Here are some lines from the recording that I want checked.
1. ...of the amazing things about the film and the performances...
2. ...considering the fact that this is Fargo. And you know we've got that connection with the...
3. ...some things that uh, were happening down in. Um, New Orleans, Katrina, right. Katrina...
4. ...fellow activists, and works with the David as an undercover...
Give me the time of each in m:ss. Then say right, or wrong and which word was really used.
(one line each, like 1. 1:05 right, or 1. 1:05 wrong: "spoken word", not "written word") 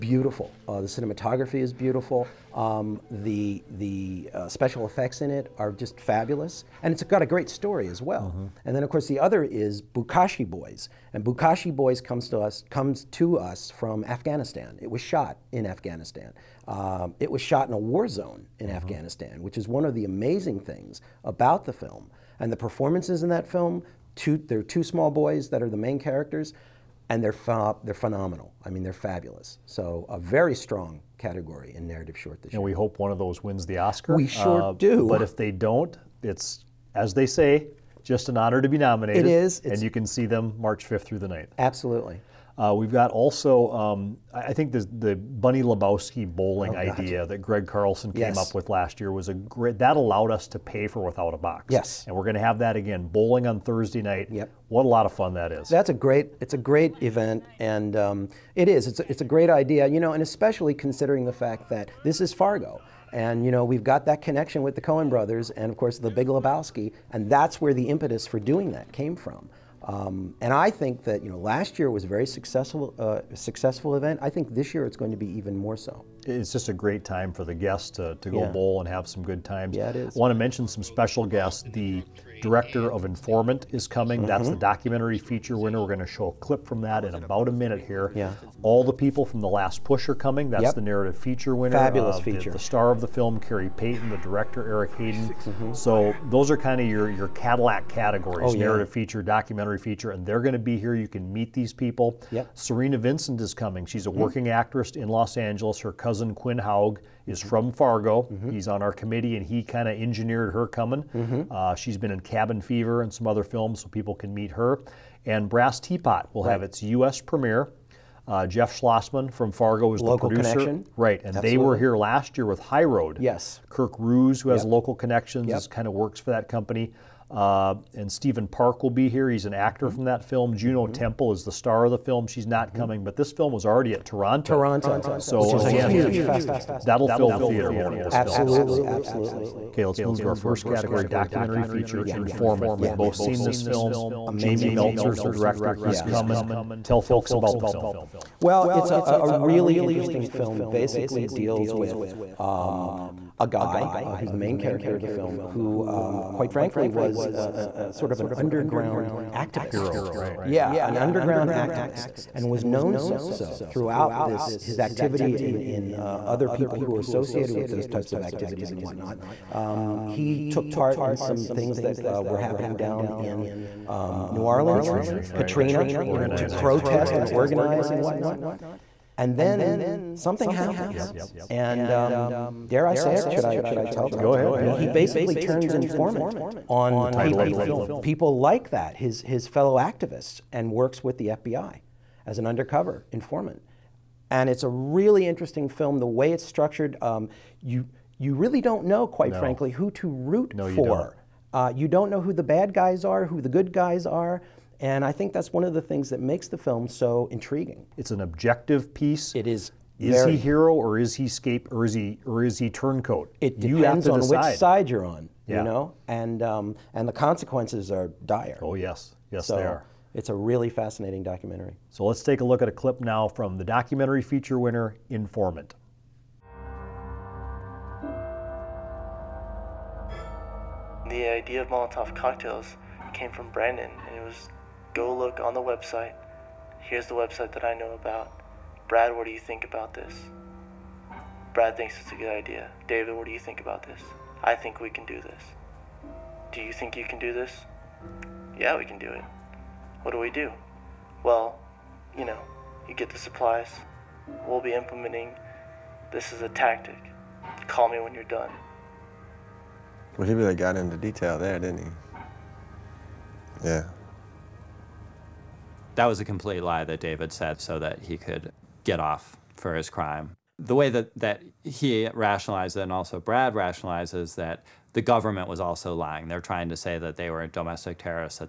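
1. 0:19 right
2. 1:00 right
3. 2:51 right
4. 3:09 wrong: "FBI", not "David".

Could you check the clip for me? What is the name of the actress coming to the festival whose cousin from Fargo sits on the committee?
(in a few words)
Cerina Vincent.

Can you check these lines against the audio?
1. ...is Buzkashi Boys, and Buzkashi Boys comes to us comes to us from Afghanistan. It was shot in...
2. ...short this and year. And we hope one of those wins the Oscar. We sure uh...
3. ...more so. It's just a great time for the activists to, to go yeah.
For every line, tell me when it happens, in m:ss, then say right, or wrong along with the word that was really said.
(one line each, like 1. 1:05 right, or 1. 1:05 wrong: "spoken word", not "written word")
1. 0:09 right
2. 0:32 right
3. 1:15 wrong: "guests", not "activists".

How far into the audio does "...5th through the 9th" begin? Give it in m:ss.
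0:40.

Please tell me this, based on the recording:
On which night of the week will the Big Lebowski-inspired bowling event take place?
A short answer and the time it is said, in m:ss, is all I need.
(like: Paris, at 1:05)
Thursday, at 0:53.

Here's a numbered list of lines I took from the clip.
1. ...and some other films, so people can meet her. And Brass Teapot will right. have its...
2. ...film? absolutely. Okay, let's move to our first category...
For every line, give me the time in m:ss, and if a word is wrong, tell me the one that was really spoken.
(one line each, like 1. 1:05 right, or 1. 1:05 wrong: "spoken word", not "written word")
1. 1:53 right
2. 2:18 right.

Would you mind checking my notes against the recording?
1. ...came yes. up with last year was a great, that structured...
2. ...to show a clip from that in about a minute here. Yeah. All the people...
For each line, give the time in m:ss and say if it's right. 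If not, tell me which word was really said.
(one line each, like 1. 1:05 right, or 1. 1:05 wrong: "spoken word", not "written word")
1. 0:48 wrong: "allowed", not "structured"
2. 1:25 right.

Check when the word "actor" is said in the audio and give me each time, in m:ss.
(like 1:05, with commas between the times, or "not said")
2:09.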